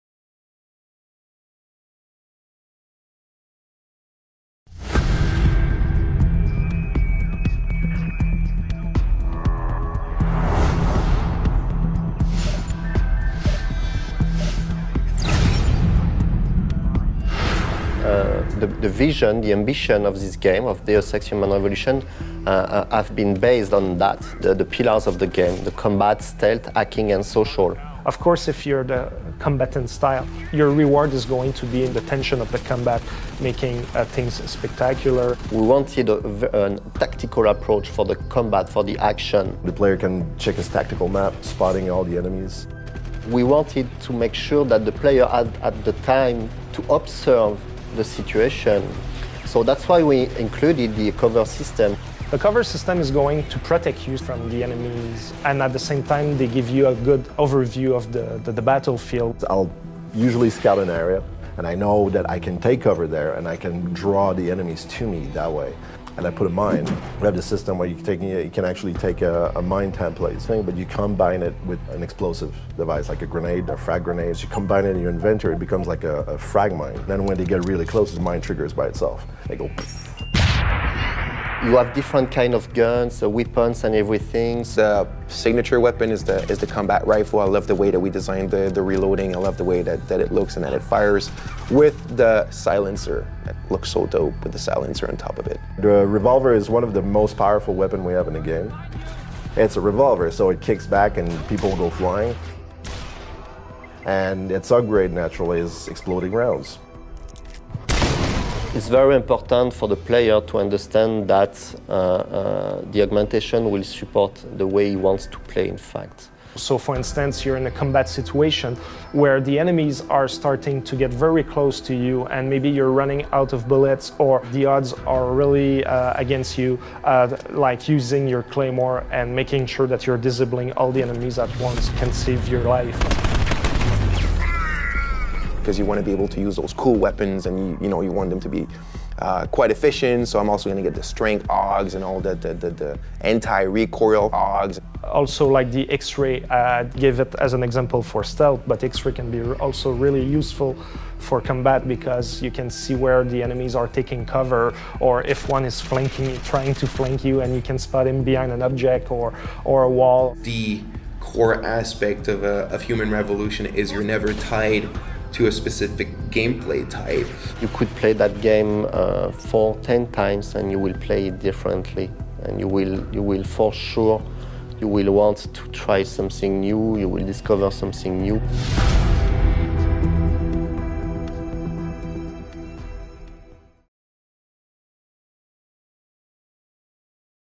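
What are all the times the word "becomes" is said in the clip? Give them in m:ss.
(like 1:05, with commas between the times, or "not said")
1:15.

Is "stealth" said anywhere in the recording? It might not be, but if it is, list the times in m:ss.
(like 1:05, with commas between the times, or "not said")
0:26, 2:28.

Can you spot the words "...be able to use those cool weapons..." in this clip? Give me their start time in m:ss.
2:16.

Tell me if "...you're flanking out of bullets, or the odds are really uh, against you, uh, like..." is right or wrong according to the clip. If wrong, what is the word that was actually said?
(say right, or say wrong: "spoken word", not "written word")
wrong: "running", not "flanking".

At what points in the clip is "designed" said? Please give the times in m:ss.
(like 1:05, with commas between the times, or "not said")
1:28.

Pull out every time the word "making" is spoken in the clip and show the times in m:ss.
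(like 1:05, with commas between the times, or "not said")
0:33, 2:09.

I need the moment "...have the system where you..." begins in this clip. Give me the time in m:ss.
1:07.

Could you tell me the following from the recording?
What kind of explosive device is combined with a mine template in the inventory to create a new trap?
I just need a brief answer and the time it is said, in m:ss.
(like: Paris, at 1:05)
Frag grenade, at 1:13.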